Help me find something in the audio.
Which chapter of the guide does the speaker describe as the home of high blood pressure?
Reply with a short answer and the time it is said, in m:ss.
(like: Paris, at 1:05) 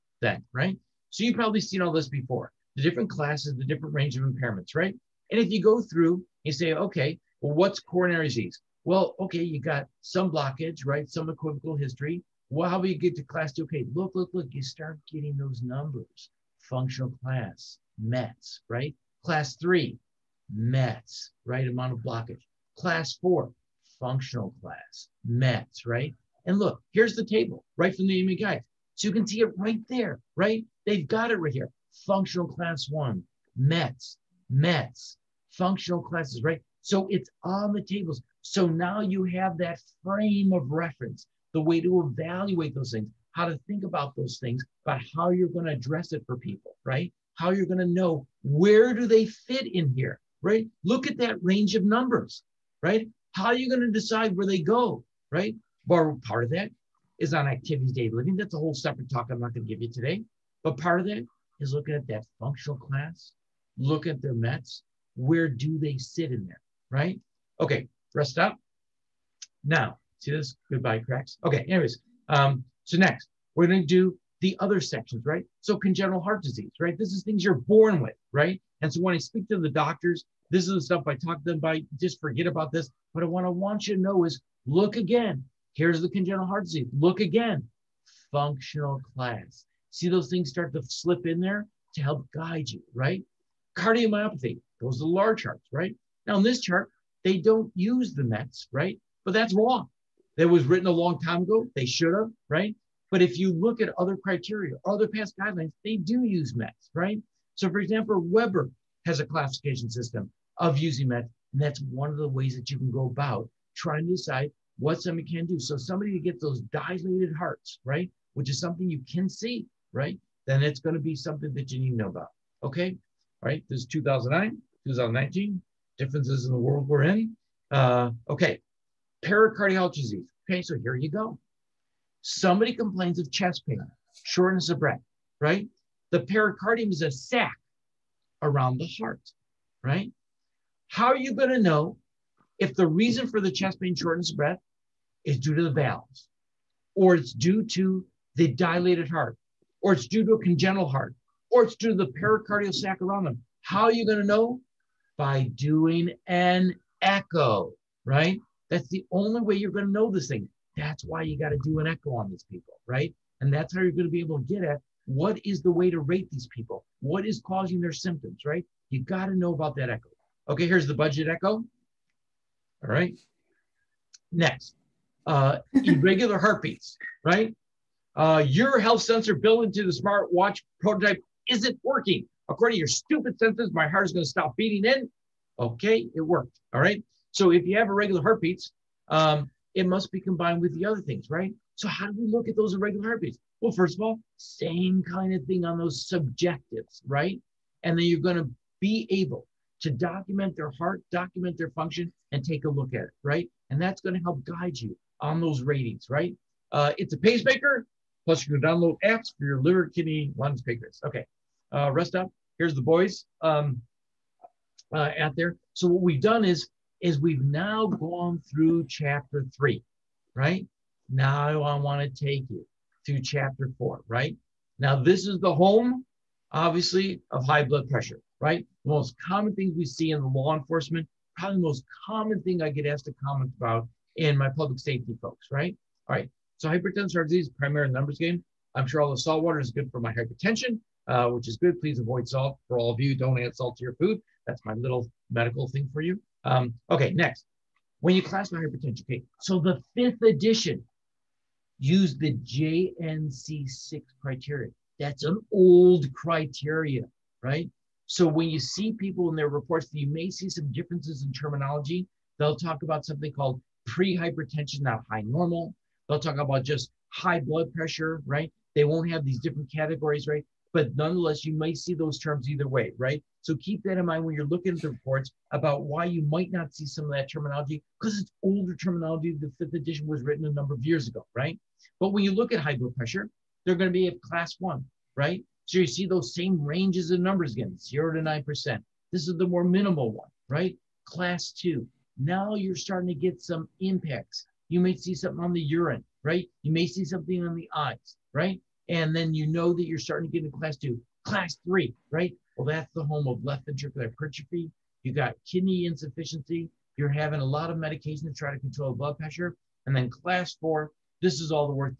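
Chapter four, at 3:43.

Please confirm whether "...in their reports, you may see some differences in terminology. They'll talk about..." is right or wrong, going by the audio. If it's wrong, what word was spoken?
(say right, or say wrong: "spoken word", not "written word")
right.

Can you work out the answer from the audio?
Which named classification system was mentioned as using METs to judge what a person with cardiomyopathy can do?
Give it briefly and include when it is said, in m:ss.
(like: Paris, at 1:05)
Weber, at 1:48.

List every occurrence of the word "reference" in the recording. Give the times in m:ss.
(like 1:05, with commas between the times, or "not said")
0:40.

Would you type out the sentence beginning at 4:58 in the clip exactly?
And then you know that you're starting to get into class two, class three, right?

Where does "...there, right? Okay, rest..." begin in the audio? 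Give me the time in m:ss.
1:06.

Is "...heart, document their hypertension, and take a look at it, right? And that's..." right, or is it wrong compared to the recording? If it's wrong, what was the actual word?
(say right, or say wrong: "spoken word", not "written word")
wrong: "function", not "hypertension".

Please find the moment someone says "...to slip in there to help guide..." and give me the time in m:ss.
1:30.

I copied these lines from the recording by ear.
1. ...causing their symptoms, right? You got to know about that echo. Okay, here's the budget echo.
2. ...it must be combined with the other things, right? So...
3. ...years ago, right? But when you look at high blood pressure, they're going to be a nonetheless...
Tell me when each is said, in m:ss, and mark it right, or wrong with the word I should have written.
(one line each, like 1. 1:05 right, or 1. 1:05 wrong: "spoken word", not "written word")
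1. 2:47 right
2. 3:09 right
3. 4:40 wrong: "class", not "nonetheless".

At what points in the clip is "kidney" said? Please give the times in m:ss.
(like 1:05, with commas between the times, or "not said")
3:29, 5:05.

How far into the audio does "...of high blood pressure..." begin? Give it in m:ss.
3:47.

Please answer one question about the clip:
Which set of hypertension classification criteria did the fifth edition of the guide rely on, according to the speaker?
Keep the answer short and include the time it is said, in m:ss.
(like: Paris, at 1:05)
JNC6, at 4:12.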